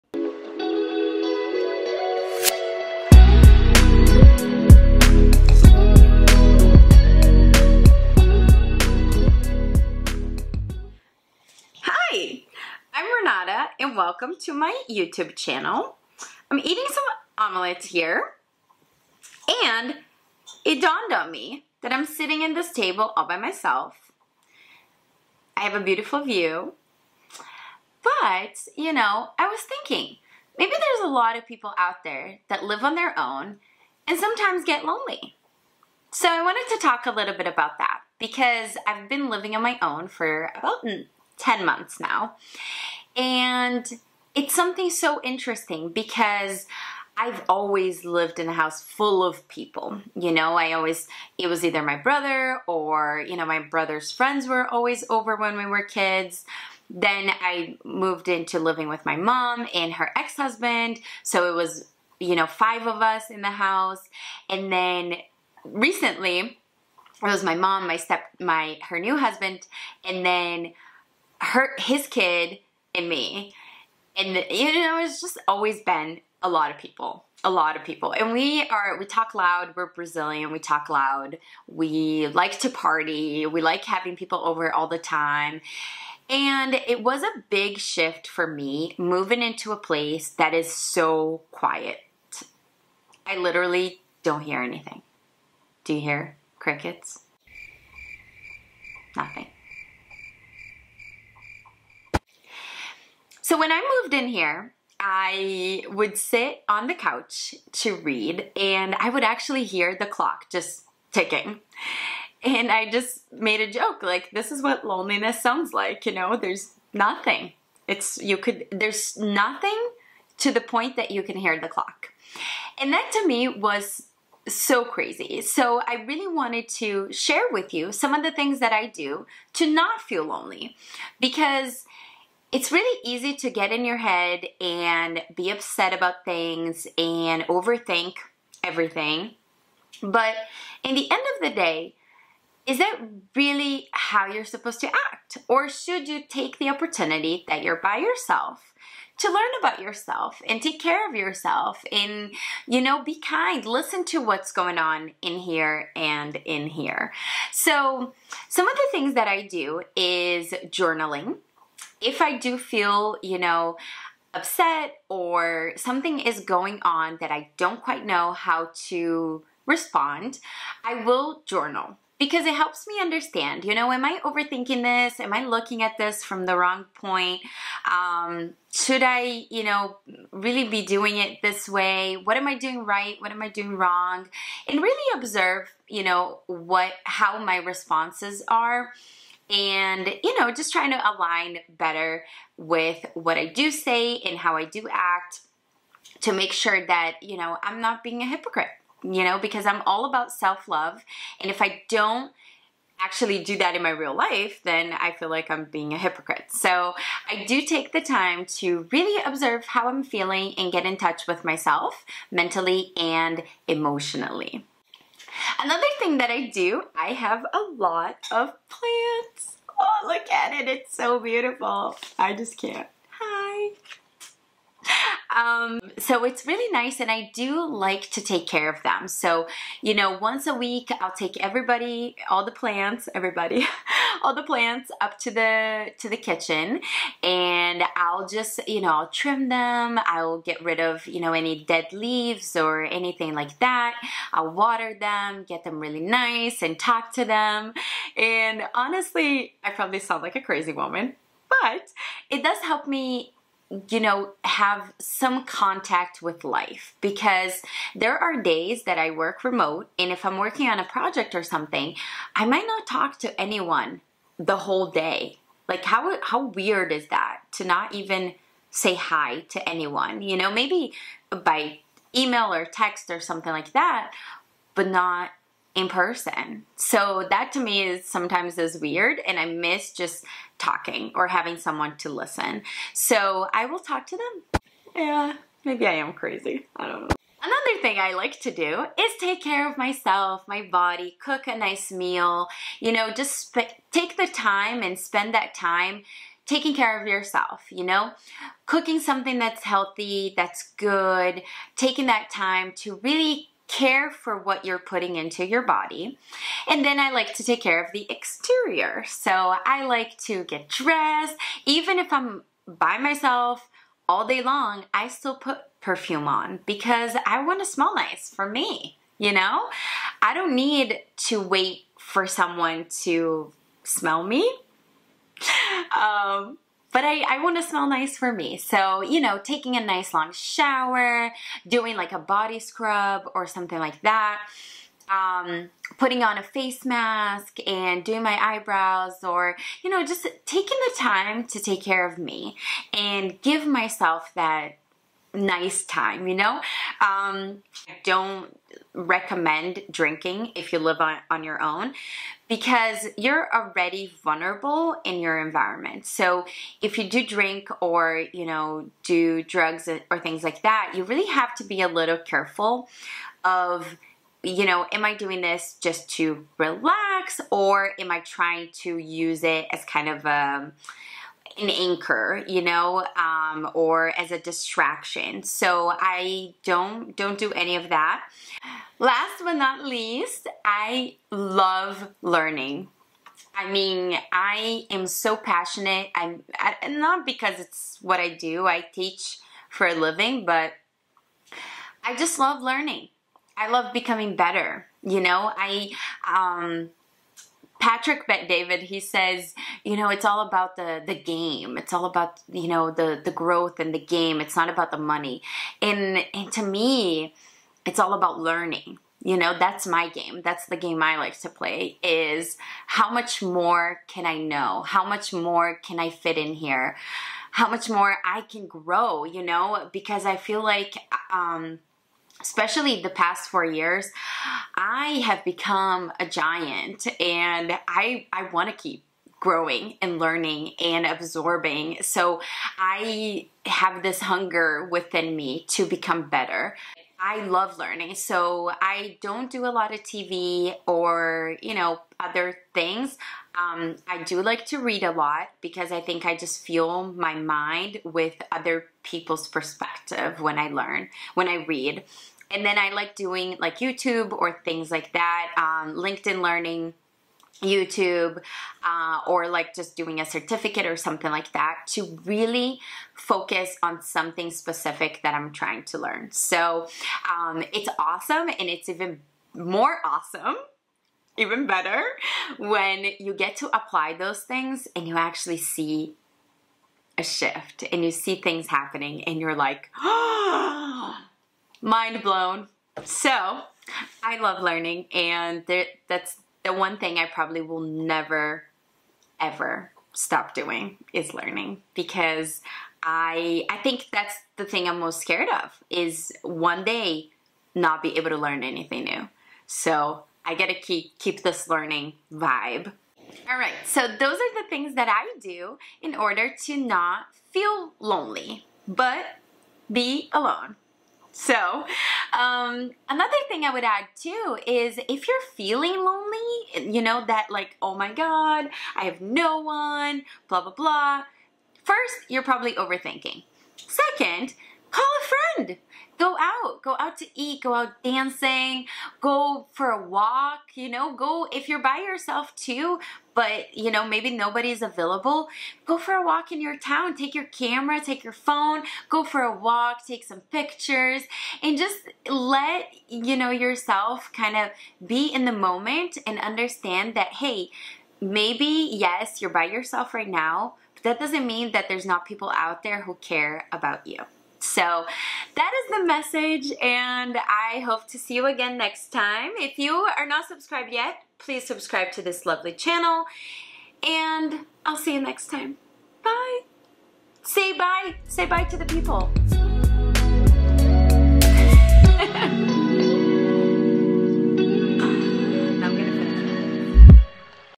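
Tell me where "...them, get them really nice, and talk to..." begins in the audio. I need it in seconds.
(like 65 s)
244 s.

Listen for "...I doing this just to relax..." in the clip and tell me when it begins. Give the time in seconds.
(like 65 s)
365 s.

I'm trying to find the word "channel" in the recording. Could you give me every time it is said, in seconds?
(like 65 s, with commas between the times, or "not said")
15 s, 562 s.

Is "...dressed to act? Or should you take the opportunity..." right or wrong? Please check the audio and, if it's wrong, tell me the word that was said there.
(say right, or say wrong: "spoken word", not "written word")
wrong: "supposed", not "dressed".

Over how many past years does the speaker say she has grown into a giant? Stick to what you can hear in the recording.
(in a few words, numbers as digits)
4.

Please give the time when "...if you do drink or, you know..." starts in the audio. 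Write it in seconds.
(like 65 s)
356 s.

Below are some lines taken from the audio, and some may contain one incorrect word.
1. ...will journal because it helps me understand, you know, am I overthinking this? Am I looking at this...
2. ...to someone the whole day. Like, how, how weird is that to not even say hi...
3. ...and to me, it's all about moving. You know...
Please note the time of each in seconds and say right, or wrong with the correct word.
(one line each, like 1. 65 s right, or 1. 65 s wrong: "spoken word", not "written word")
1. 171 s right
2. 263 s wrong: "anyone", not "someone"
3. 406 s wrong: "learning", not "moving".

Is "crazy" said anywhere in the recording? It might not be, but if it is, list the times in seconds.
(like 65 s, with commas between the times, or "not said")
124 s, 250 s, 286 s.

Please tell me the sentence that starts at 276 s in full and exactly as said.
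So that to me is sometimes is weird and I miss just talking or having someone to listen.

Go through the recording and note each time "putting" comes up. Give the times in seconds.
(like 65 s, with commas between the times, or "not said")
304 s, 335 s.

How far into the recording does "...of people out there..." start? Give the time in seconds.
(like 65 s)
31 s.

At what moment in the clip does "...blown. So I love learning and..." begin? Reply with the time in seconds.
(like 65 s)
482 s.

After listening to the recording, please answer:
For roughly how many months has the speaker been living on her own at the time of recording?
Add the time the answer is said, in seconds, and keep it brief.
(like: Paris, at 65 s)
10, at 41 s.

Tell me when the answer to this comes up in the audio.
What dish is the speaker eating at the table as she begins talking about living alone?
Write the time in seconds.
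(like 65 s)
17 s.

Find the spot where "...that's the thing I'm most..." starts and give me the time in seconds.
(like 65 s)
494 s.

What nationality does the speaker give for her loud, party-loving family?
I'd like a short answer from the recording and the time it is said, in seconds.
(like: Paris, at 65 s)
Brazilian, at 79 s.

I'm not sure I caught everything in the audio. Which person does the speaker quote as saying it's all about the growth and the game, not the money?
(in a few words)
Patrick Bet David.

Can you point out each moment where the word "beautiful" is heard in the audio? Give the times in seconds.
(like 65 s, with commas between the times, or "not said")
25 s, 221 s.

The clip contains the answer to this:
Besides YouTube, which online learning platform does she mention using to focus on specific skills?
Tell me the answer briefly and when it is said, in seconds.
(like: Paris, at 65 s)
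LinkedIn Learning, at 455 s.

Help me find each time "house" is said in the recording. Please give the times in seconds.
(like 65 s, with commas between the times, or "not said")
48 s, 63 s.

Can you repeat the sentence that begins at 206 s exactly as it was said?
So I do take the time to really observe how I'm feeling and get in touch with myself mentally and emotionally.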